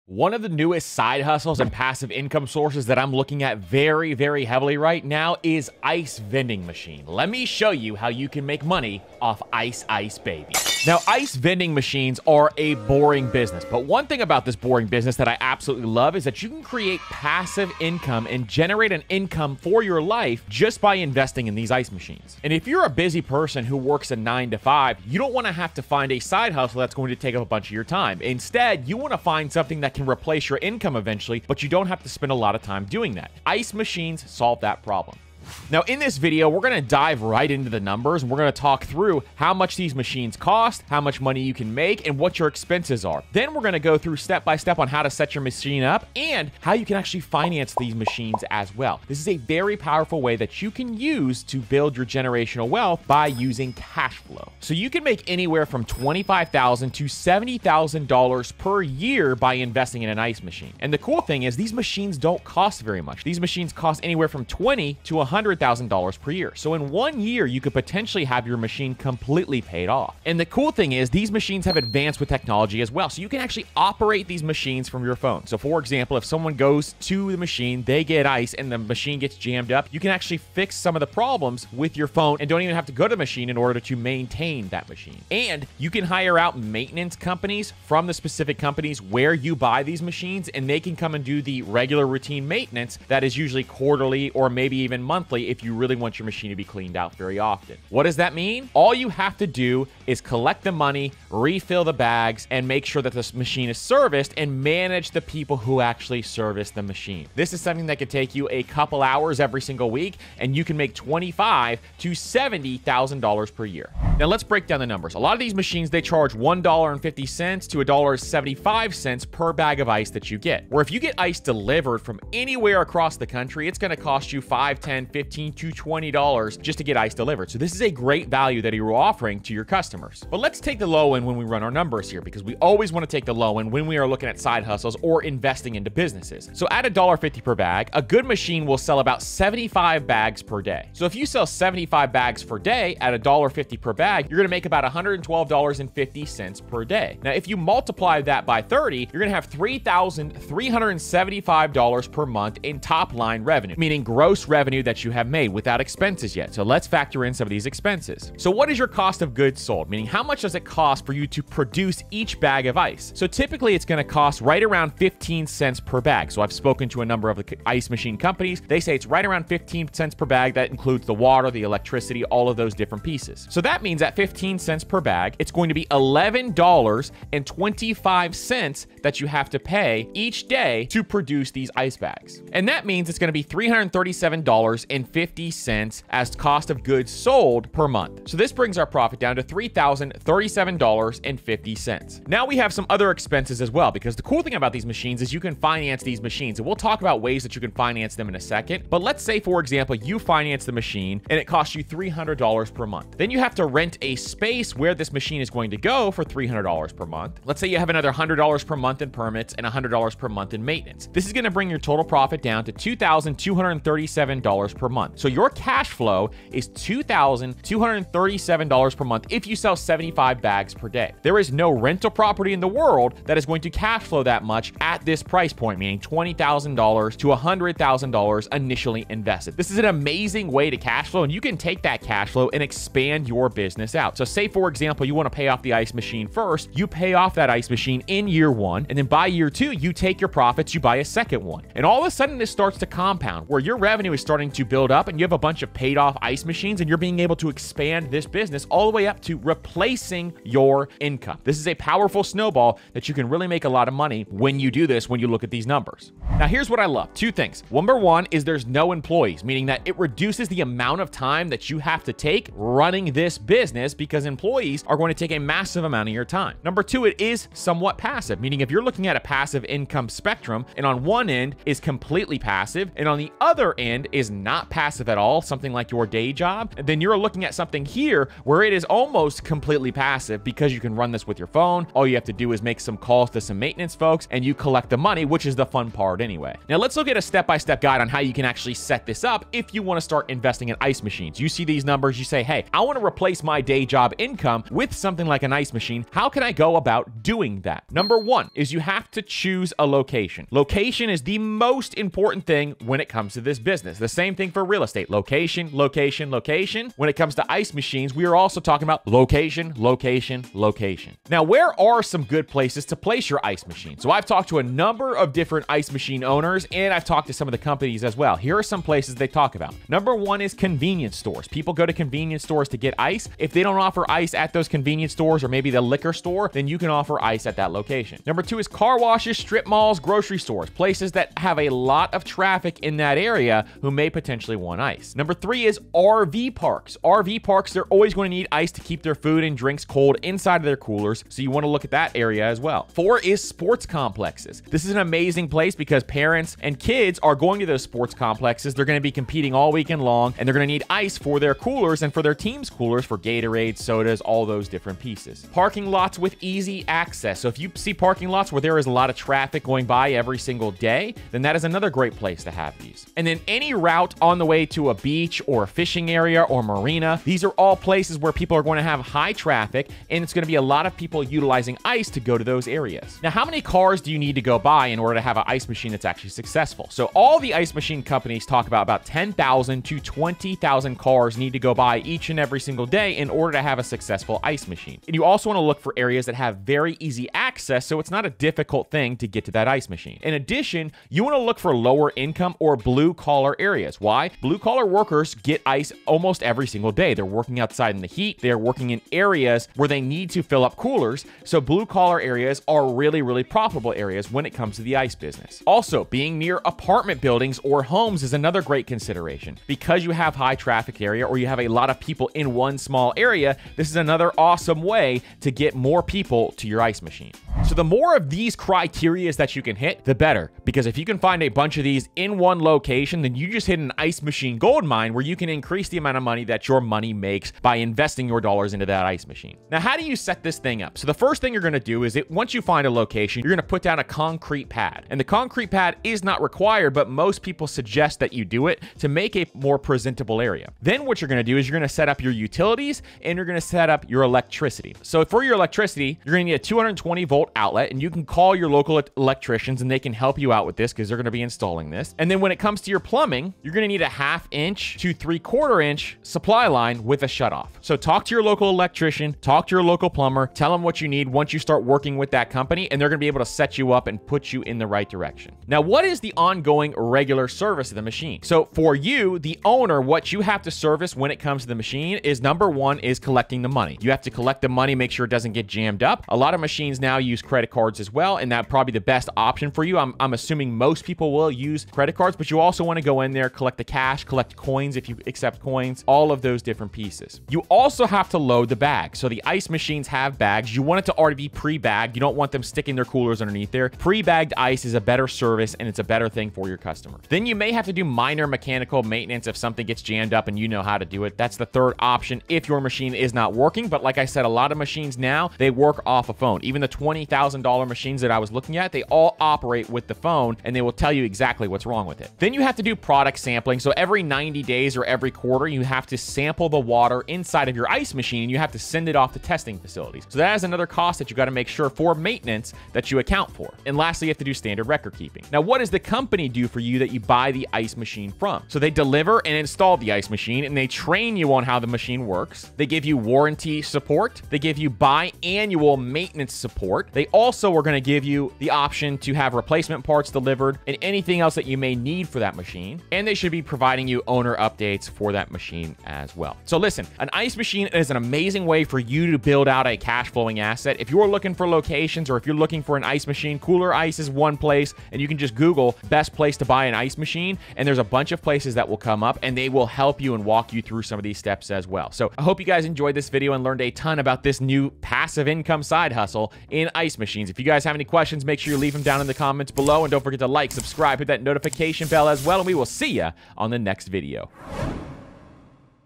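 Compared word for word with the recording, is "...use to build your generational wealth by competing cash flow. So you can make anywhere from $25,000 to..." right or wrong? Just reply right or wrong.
wrong.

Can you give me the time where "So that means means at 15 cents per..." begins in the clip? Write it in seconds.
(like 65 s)
173 s.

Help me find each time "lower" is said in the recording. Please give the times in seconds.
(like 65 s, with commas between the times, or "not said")
391 s.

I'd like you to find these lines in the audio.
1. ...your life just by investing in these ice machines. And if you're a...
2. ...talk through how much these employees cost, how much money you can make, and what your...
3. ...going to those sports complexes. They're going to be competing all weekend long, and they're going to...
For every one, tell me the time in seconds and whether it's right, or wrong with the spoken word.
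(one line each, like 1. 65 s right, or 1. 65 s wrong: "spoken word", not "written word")
1. 19 s right
2. 38 s wrong: "machines", not "employees"
3. 347 s right.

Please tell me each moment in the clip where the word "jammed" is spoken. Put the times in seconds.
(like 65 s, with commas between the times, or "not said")
79 s, 475 s, 500 s.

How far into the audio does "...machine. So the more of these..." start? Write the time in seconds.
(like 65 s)
417 s.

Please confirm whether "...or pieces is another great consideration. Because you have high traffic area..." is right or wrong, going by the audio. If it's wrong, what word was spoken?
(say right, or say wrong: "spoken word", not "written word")
wrong: "homes", not "pieces".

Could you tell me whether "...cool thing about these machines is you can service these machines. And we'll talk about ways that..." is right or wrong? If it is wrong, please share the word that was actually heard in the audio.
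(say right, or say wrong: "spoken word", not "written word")
wrong: "finance", not "service".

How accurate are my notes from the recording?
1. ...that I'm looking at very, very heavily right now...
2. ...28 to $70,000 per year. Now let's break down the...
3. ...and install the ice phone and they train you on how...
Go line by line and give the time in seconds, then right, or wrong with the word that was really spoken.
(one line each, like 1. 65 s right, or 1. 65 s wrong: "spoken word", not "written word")
1. 2 s right
2. 110 s wrong: "25", not "28"
3. 529 s wrong: "machine", not "phone".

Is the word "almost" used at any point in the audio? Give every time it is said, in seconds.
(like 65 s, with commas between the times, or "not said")
278 s, 396 s.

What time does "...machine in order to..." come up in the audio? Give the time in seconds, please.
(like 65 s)
83 s.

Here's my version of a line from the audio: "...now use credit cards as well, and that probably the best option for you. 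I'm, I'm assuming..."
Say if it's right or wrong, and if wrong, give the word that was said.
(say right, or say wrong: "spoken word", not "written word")
right.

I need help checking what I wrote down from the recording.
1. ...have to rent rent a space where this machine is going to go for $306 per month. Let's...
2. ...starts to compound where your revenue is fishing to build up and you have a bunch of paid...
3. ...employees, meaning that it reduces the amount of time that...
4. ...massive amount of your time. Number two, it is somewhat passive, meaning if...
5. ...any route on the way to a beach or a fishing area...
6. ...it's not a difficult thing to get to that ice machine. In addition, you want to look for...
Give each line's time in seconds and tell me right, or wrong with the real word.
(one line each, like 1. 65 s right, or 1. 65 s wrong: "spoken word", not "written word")
1. 203 s wrong: "300", not "306"
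2. 242 s wrong: "starting", not "fishing"
3. 258 s right
4. 265 s right
5. 363 s right
6. 387 s right.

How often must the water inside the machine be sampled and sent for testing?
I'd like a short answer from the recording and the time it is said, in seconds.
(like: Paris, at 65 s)
Every 90 days, at 513 s.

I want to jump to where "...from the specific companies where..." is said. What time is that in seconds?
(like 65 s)
87 s.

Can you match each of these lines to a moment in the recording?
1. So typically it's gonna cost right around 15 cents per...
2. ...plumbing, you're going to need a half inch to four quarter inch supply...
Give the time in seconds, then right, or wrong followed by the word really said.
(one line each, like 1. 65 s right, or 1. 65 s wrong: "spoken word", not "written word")
1. 163 s right
2. 452 s wrong: "three", not "four".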